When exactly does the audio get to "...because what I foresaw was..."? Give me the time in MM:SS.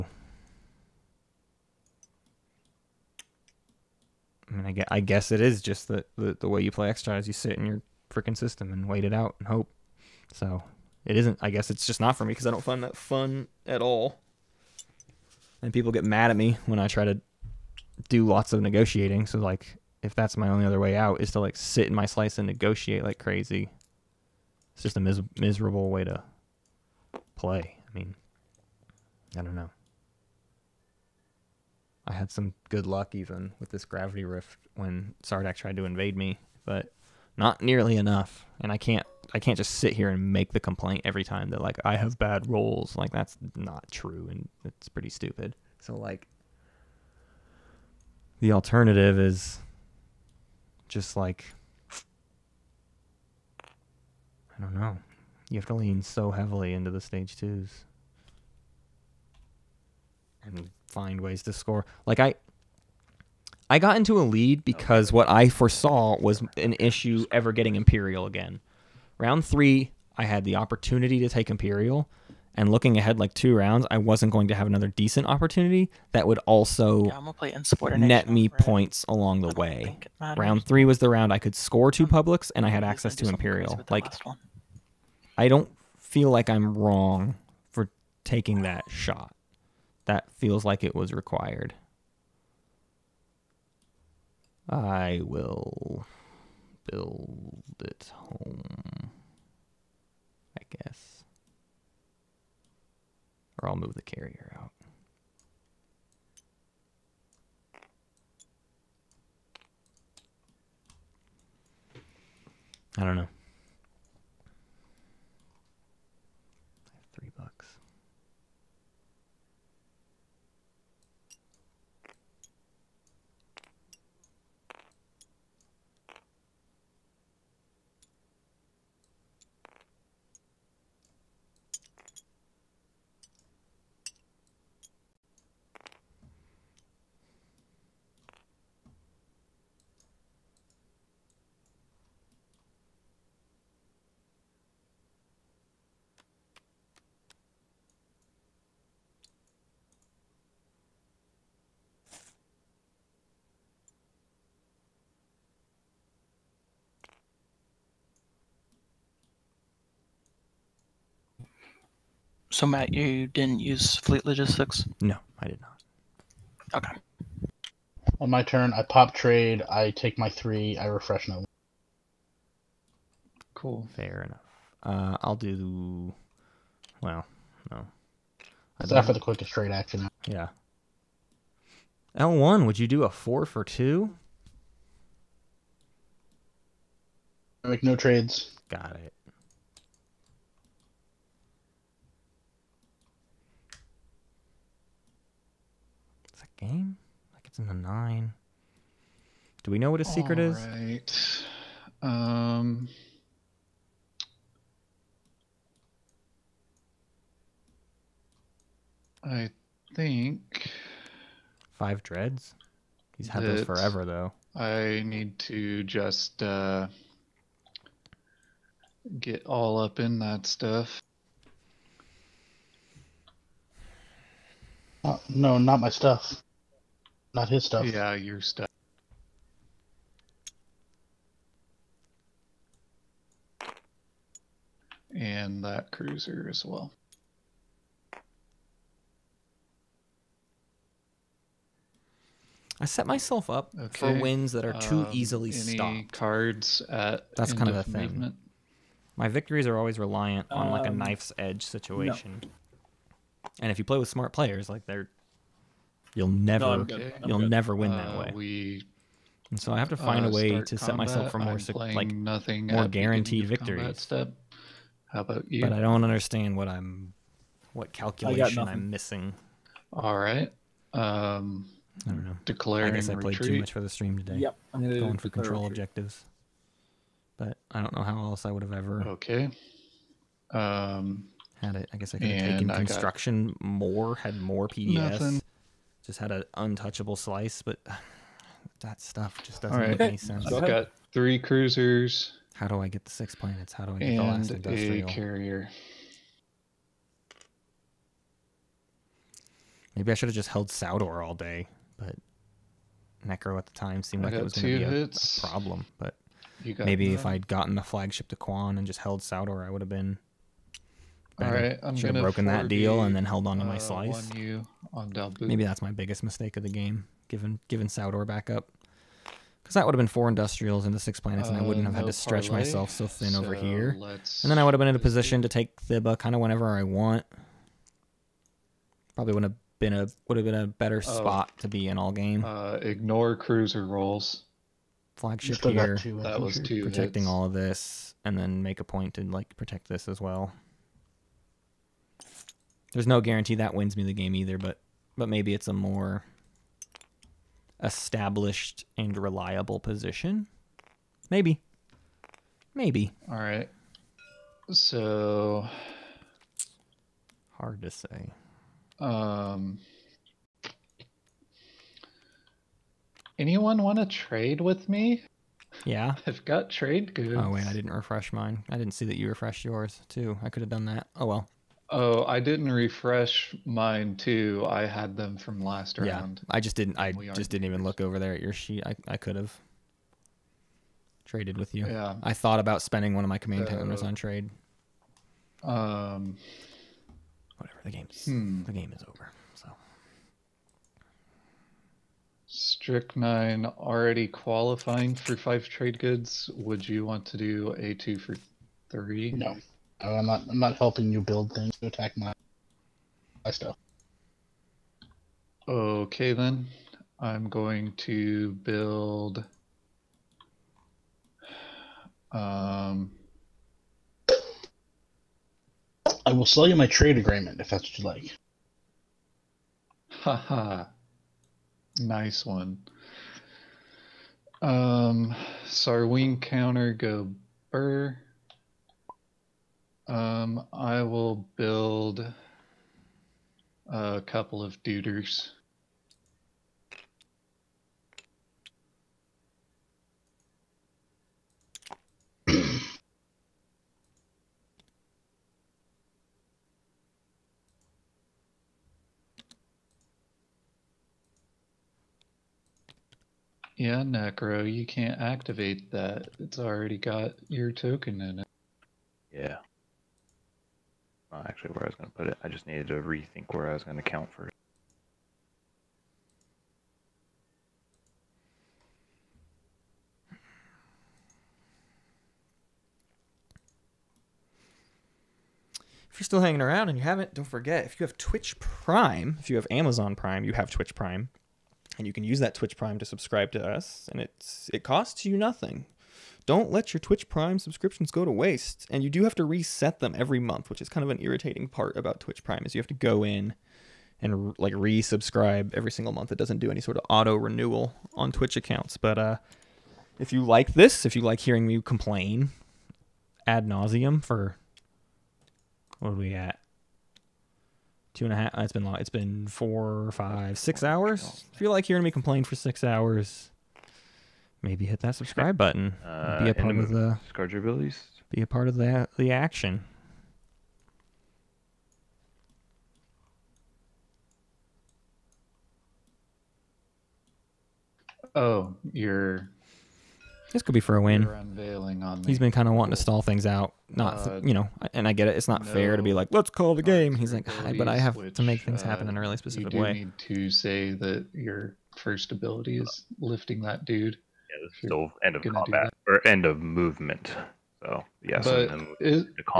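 01:04.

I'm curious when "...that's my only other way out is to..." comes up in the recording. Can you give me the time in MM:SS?
00:20.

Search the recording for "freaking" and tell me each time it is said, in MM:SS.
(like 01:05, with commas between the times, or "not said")
00:08.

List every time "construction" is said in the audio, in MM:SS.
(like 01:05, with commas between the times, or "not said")
04:42.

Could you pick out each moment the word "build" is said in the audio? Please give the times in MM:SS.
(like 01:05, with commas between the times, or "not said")
01:36, 06:41, 06:48, 07:11.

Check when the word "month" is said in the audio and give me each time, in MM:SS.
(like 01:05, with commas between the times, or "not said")
08:10, 08:16.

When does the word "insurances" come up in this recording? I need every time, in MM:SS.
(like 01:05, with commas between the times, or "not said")
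not said.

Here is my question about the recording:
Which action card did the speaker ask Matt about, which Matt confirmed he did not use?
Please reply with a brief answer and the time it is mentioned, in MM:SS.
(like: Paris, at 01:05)
Fleet Logistics, at 02:43.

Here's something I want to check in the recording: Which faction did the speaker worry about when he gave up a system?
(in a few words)
Nekro.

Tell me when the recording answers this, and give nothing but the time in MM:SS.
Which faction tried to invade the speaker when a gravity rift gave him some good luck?
00:35.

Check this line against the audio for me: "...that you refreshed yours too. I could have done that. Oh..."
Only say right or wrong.
right.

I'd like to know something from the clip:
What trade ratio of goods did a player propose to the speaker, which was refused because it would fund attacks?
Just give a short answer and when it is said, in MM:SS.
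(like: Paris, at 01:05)
2 for 3, at 06:37.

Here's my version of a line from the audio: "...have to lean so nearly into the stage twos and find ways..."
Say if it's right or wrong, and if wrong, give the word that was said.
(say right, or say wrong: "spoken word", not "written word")
wrong: "heavily", not "nearly".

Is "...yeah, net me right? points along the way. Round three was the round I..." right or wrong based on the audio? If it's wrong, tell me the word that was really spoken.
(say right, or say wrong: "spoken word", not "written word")
right.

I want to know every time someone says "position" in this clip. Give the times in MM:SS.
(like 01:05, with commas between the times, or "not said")
05:25, 05:49.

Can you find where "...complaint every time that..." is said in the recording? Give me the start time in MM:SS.
00:40.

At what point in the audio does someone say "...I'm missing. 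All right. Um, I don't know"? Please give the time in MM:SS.
04:28.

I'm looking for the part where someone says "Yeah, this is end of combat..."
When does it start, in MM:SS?
09:04.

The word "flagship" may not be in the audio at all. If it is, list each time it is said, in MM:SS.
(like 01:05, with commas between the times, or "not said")
05:07, 05:35.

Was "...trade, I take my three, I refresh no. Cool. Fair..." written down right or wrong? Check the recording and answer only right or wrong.
right.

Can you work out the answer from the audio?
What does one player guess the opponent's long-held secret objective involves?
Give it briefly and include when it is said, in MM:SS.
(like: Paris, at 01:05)
5 dreads, at 03:31.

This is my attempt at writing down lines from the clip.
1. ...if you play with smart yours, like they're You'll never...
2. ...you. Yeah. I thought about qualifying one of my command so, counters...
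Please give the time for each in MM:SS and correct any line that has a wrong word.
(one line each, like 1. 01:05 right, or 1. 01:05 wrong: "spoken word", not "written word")
1. 04:13 wrong: "players", not "yours"
2. 06:21 wrong: "spending", not "qualifying".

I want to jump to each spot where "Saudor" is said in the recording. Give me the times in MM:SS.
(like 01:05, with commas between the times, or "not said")
05:00, 05:09, 05:17.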